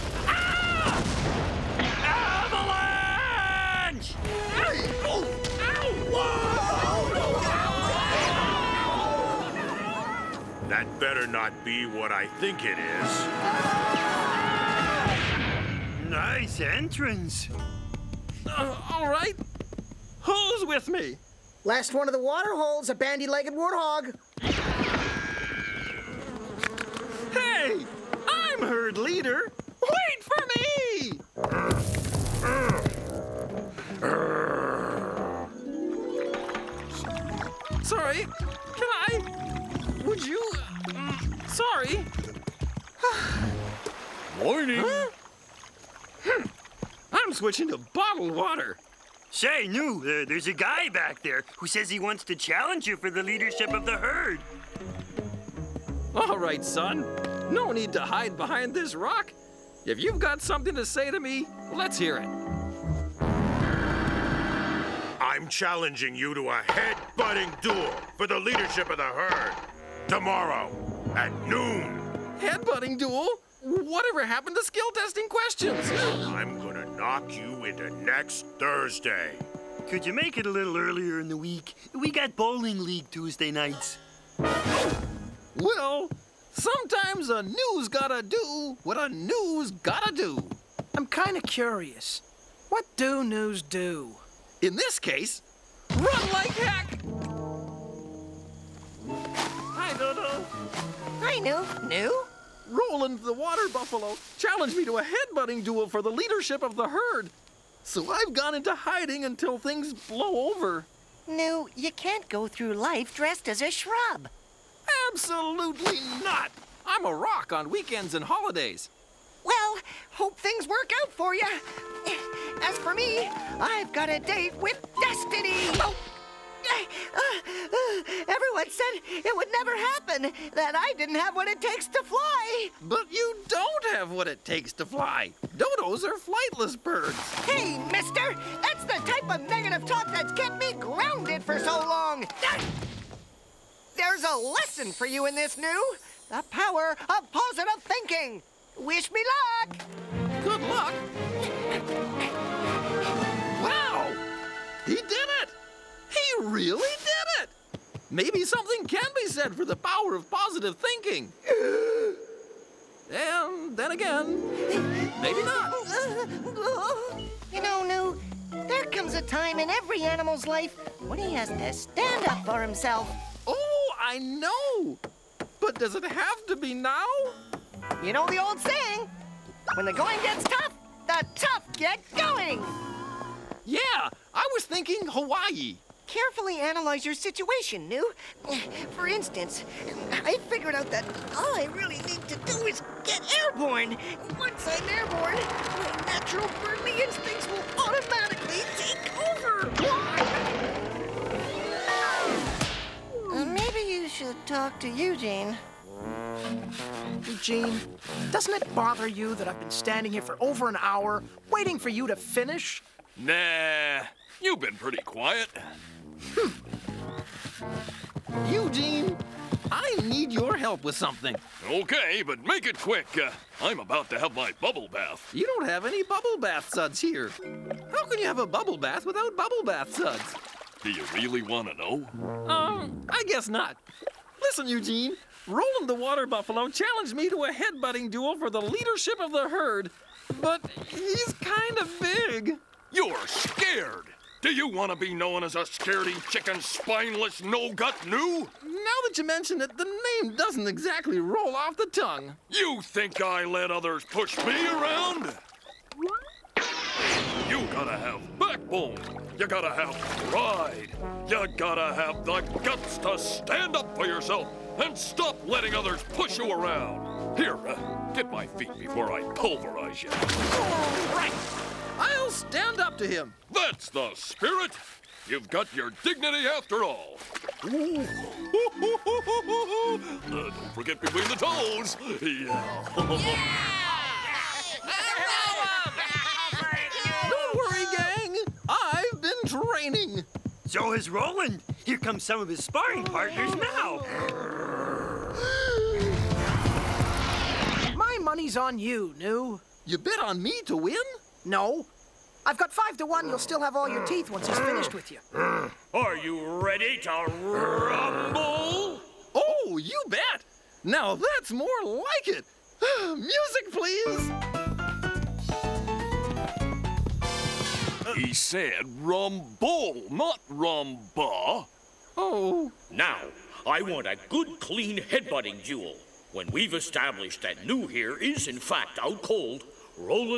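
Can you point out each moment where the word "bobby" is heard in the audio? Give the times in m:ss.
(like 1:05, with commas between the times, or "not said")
not said.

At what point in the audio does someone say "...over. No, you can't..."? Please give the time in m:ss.
1:50.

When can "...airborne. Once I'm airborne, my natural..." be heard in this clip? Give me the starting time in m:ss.
3:13.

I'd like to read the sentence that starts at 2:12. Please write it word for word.
But you don't have what it takes to fly.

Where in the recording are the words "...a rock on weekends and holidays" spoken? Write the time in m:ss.
1:57.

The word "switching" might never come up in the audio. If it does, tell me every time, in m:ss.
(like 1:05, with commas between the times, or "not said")
0:47.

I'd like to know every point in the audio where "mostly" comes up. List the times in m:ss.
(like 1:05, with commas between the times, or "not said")
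not said.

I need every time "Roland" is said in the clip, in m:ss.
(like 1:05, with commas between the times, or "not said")
1:42, 3:55, 4:51.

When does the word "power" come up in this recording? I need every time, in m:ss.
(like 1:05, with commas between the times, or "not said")
2:26, 2:39.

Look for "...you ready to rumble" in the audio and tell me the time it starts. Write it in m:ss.
5:06.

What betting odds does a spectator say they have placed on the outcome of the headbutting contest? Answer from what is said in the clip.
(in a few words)
5 to 1.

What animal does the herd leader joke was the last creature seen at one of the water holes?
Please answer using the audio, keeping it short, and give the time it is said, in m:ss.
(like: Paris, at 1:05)
bandy-legged warthog, at 0:22.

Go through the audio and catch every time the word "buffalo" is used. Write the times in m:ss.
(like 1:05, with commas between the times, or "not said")
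1:43, 3:56.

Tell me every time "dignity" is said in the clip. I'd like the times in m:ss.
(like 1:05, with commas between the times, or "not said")
4:36.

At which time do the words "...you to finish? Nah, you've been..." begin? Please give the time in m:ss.
3:31.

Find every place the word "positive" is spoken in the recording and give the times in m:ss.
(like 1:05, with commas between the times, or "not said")
2:27, 2:40.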